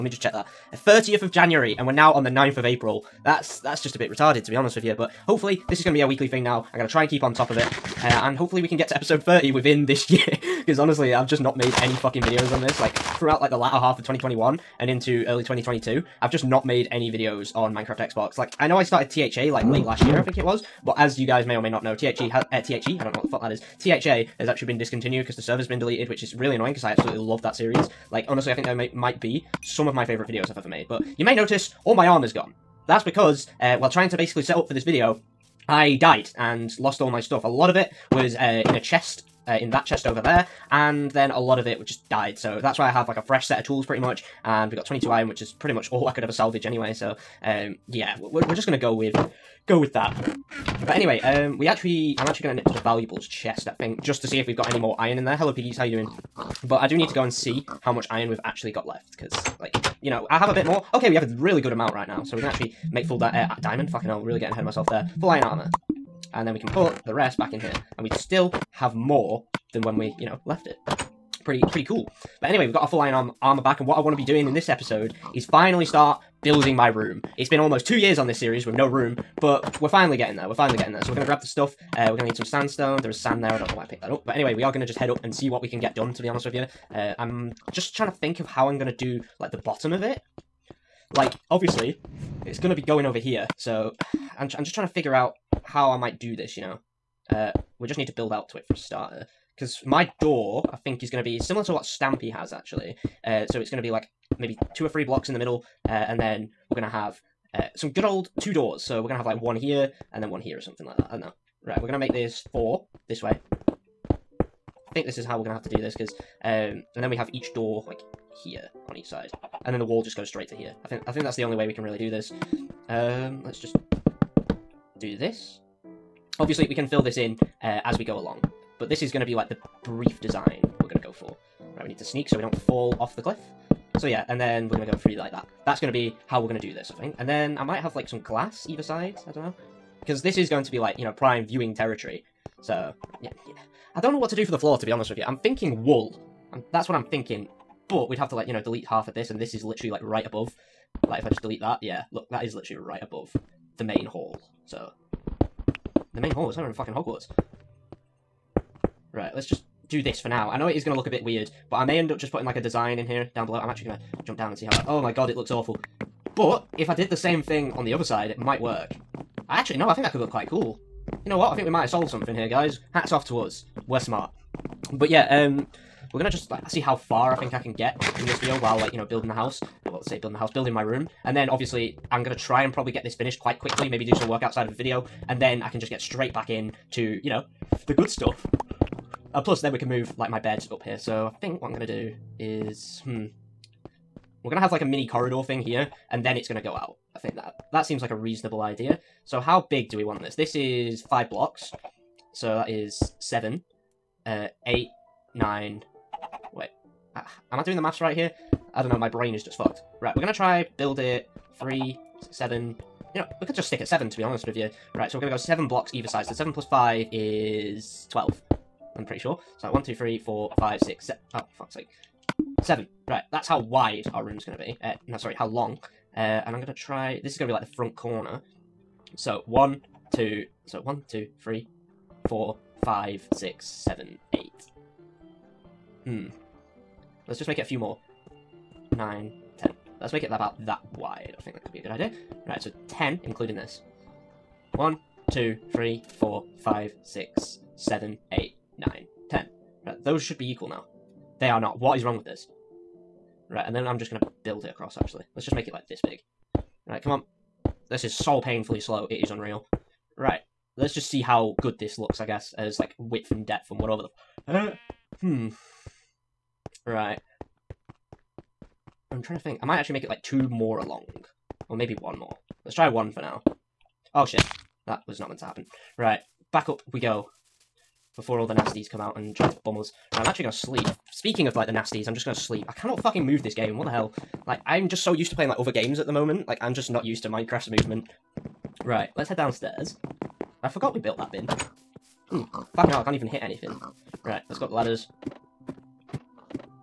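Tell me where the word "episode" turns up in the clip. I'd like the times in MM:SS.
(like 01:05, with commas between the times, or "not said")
00:08, 01:14.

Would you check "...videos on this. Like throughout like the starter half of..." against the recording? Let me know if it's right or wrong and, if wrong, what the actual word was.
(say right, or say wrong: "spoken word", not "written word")
wrong: "latter", not "starter".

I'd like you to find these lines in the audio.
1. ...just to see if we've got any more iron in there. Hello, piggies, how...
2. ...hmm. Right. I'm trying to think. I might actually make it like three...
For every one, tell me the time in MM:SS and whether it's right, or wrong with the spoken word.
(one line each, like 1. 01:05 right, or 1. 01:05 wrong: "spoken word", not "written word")
1. 00:54 right
2. 04:25 wrong: "two", not "three".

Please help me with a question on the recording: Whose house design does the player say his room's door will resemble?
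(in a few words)
Stampy.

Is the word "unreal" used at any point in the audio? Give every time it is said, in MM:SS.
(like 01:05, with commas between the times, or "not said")
04:19.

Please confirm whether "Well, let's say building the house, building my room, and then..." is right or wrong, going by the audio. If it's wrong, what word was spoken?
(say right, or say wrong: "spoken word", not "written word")
right.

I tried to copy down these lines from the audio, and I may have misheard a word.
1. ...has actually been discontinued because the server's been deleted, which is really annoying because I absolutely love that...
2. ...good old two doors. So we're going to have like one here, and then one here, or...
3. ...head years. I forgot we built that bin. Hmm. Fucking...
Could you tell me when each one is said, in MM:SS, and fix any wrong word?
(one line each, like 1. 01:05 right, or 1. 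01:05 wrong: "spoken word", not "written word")
1. 00:24 right
2. 01:47 right
3. 04:49 wrong: "downstairs", not "years".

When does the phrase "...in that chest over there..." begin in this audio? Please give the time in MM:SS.
00:39.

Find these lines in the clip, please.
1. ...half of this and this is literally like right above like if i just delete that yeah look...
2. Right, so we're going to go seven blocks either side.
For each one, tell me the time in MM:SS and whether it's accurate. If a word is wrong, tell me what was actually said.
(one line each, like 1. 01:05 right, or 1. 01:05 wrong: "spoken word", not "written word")
1. 02:28 right
2. 03:34 right.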